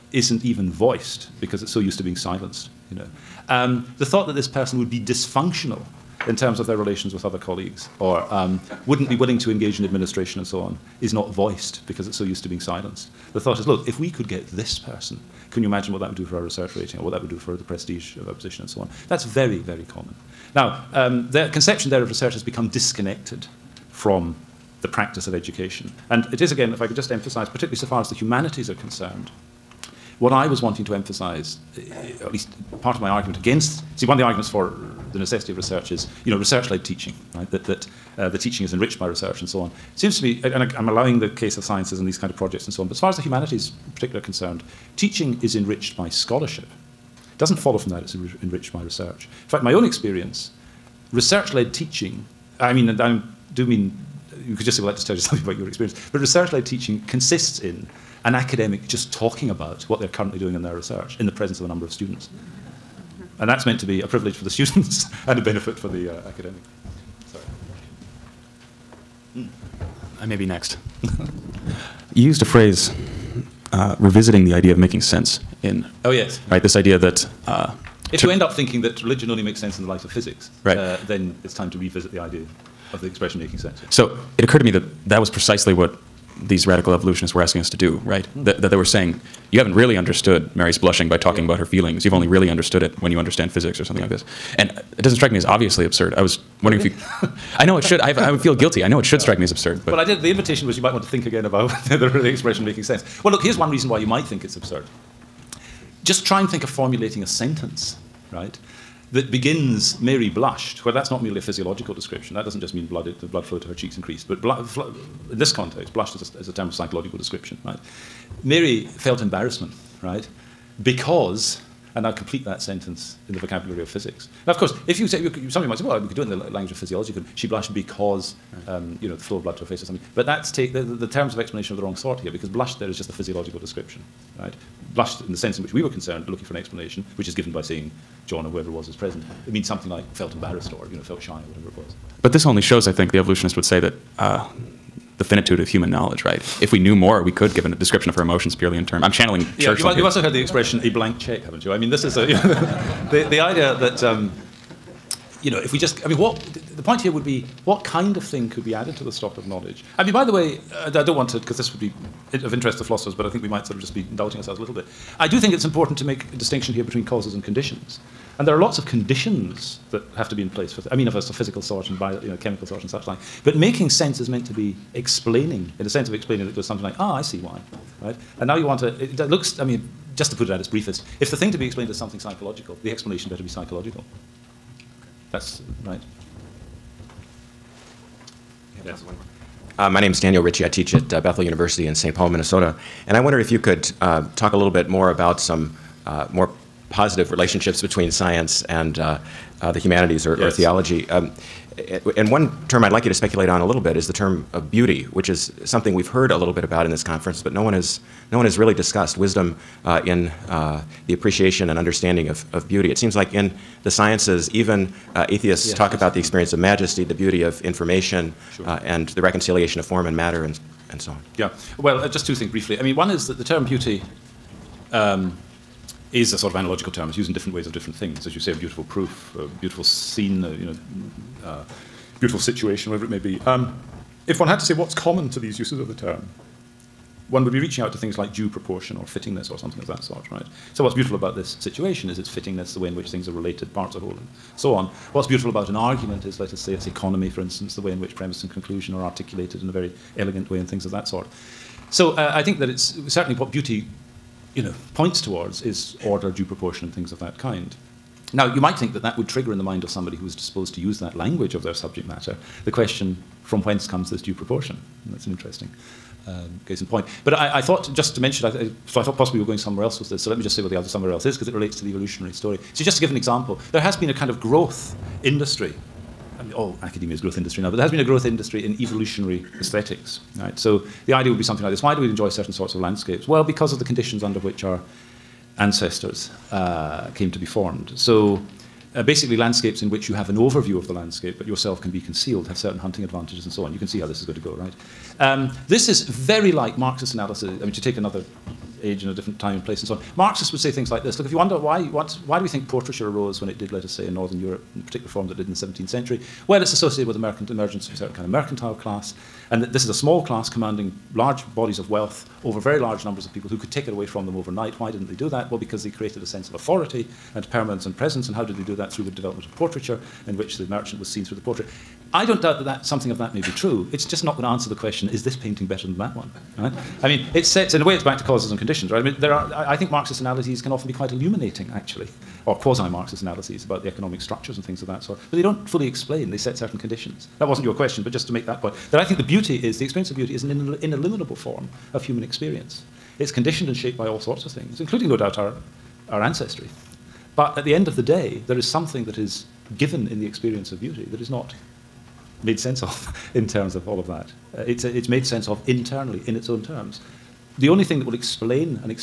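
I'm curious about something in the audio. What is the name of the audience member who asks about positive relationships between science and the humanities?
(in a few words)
Daniel Ritchie.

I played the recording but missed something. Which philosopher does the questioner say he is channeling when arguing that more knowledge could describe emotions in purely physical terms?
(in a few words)
Churchland.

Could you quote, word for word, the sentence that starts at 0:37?
That, that uh, the teaching is enriched by research and so on.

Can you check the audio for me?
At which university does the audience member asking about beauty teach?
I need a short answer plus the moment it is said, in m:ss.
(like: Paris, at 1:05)
Bethel University, at 3:11.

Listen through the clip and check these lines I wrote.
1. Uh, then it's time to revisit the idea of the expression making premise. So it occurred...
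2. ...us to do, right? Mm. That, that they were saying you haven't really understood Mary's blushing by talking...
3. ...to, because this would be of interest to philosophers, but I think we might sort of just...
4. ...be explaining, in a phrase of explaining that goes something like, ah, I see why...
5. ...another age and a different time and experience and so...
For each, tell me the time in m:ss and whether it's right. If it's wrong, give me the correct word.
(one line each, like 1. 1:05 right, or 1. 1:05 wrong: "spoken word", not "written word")
1. 1:20 wrong: "sense", not "premise"
2. 1:27 right
3. 2:41 right
4. 2:54 wrong: "sense", not "phrase"
5. 4:57 wrong: "place", not "experience".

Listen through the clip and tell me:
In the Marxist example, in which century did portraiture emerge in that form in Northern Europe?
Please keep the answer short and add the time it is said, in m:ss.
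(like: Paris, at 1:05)
17th century, at 5:05.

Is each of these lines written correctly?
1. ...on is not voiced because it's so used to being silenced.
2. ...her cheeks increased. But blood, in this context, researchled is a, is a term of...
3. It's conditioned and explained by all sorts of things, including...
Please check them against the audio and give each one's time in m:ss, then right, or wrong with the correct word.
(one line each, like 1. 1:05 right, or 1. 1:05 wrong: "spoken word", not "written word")
1. 0:10 right
2. 1:53 wrong: "blushed", not "researchled"
3. 5:43 wrong: "shaped", not "explained".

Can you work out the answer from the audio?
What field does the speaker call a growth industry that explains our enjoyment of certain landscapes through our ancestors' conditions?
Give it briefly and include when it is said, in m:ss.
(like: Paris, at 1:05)
evolutionary aesthetics, at 4:38.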